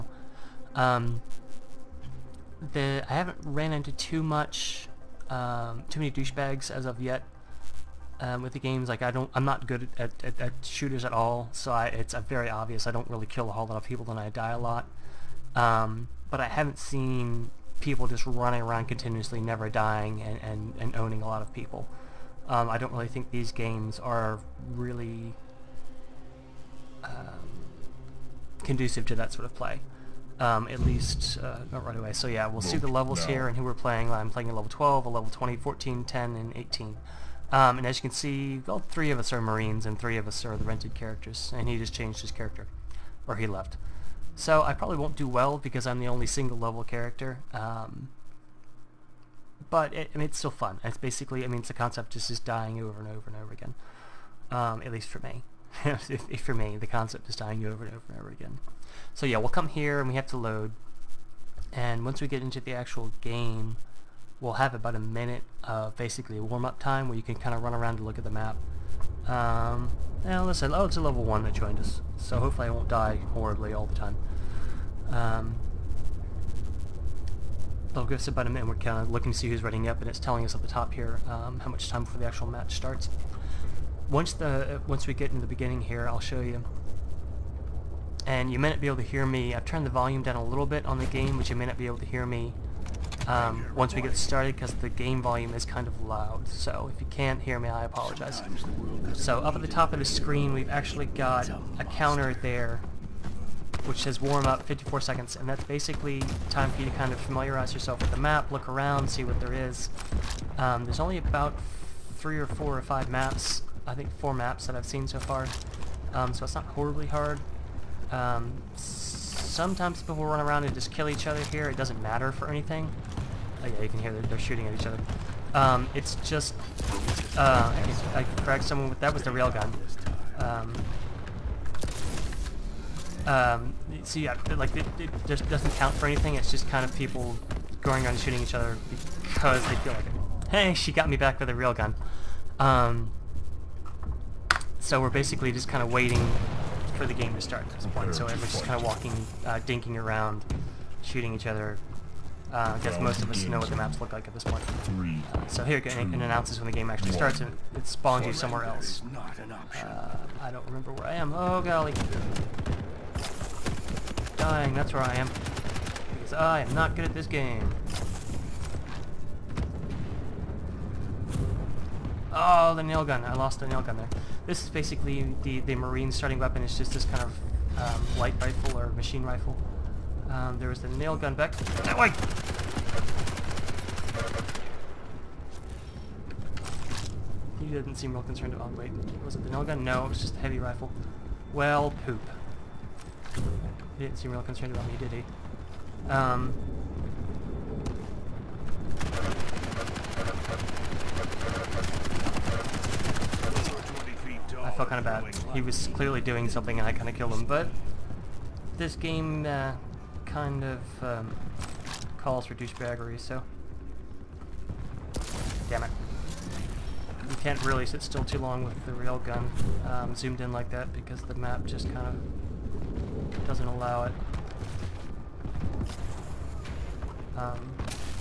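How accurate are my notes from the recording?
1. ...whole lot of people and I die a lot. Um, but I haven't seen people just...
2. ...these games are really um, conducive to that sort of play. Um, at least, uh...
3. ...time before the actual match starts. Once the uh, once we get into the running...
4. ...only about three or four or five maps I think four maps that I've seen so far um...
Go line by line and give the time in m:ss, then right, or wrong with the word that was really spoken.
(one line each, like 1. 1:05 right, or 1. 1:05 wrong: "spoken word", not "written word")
1. 0:13 right
2. 0:23 right
3. 1:21 wrong: "beginning", not "running"
4. 1:50 right.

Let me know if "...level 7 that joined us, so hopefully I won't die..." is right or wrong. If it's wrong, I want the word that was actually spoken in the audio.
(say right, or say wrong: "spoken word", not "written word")
wrong: "1", not "7".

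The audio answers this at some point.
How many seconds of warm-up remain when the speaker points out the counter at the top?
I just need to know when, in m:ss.
1:44.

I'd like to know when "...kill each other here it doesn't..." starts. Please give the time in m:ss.
2:00.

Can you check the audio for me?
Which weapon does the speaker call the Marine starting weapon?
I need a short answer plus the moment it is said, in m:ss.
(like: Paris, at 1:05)
light rifle, at 2:58.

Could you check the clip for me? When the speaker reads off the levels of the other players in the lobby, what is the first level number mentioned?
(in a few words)
12.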